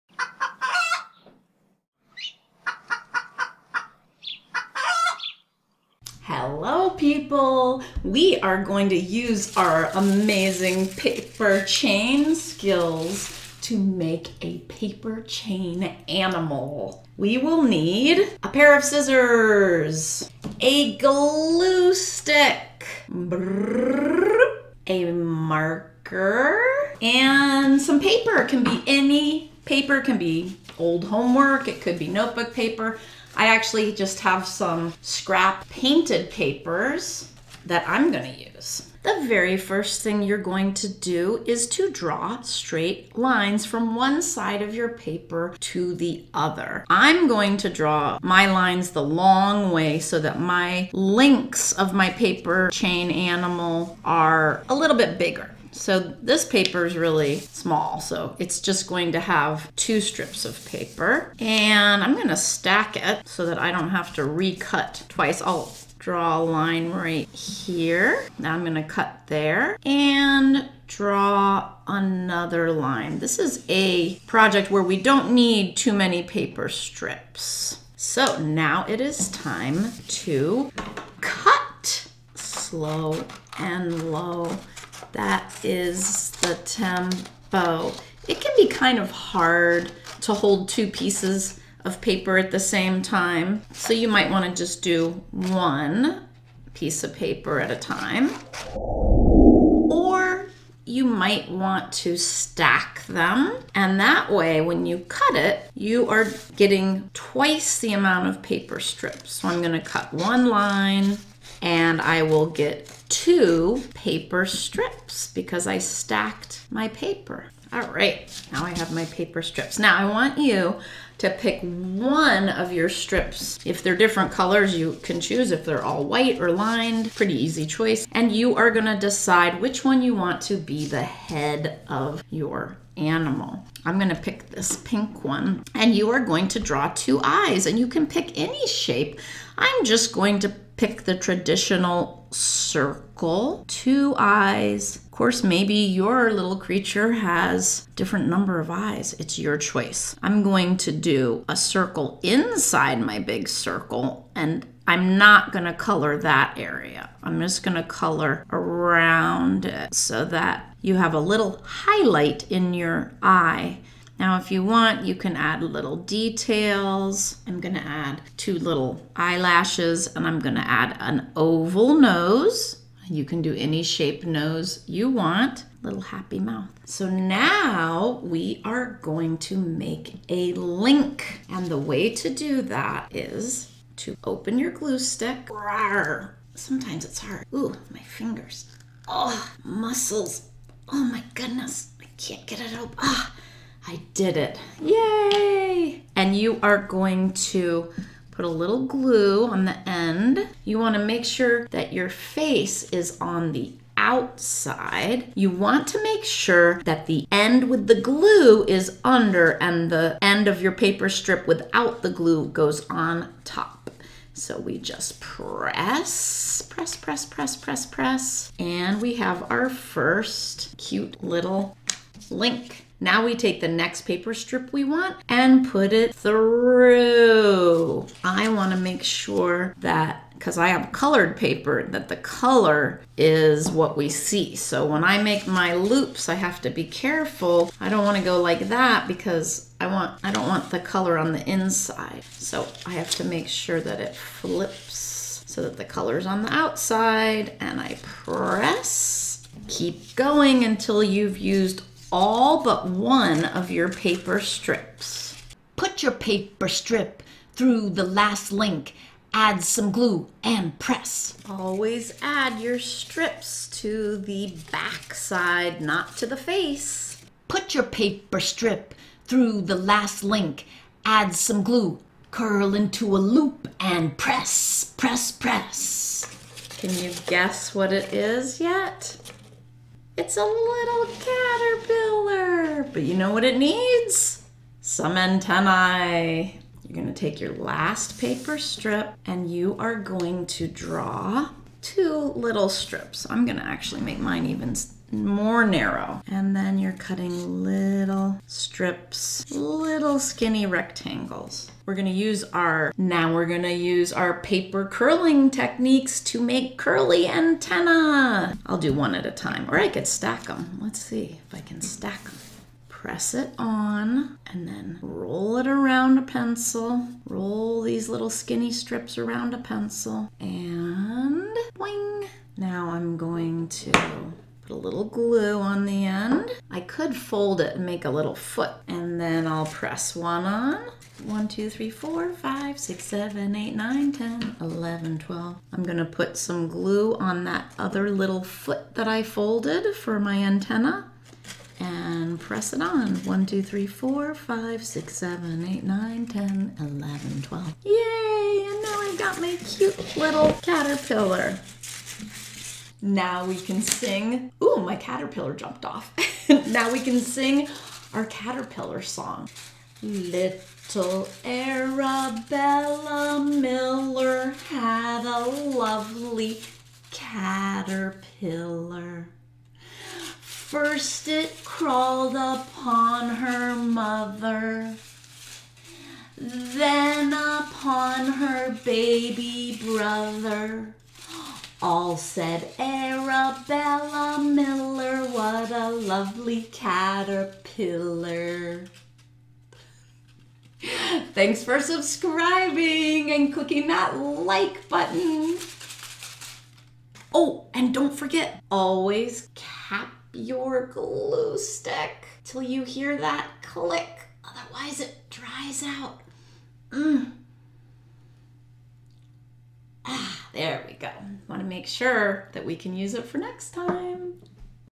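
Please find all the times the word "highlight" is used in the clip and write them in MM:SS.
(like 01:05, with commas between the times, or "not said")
02:41.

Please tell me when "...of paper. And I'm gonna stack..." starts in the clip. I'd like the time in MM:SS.
01:00.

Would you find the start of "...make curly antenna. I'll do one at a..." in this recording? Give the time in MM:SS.
05:06.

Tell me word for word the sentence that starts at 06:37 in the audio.
Oh, and don't forget, always cap your glue stick till you hear that click.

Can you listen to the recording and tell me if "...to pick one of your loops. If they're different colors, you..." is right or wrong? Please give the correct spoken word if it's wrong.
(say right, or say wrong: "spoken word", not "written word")
wrong: "strips", not "loops".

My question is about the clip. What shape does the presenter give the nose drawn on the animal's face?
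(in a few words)
oval.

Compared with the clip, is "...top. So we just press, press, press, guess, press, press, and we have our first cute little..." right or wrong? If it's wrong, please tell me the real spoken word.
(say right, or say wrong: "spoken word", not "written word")
wrong: "press", not "guess".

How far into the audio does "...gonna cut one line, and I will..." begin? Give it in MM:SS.
01:49.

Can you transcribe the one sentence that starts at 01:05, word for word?
I'll draw a line right here.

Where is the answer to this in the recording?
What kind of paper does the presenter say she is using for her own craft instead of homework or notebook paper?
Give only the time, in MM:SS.
00:35.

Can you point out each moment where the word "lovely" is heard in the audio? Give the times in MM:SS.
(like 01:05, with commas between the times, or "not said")
06:05, 06:25.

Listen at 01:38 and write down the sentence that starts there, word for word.
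Or you might want to stack them.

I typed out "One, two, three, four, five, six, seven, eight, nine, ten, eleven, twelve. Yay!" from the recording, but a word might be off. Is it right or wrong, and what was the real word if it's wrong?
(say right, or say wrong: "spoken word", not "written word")
right.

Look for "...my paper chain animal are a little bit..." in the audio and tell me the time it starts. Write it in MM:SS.
00:51.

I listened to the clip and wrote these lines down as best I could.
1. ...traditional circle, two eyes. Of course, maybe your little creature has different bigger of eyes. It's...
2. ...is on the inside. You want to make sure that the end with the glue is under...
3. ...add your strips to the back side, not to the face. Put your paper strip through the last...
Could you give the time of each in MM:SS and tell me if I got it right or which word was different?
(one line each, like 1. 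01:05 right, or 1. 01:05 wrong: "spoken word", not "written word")
1. 02:21 wrong: "number", not "bigger"
2. 03:22 wrong: "outside", not "inside"
3. 04:22 right.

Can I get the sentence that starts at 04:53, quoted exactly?
I'm gonna actually make mine even more narrow.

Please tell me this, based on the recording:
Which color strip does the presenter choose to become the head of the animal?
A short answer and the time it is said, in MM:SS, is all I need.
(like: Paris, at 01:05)
pink, at 02:14.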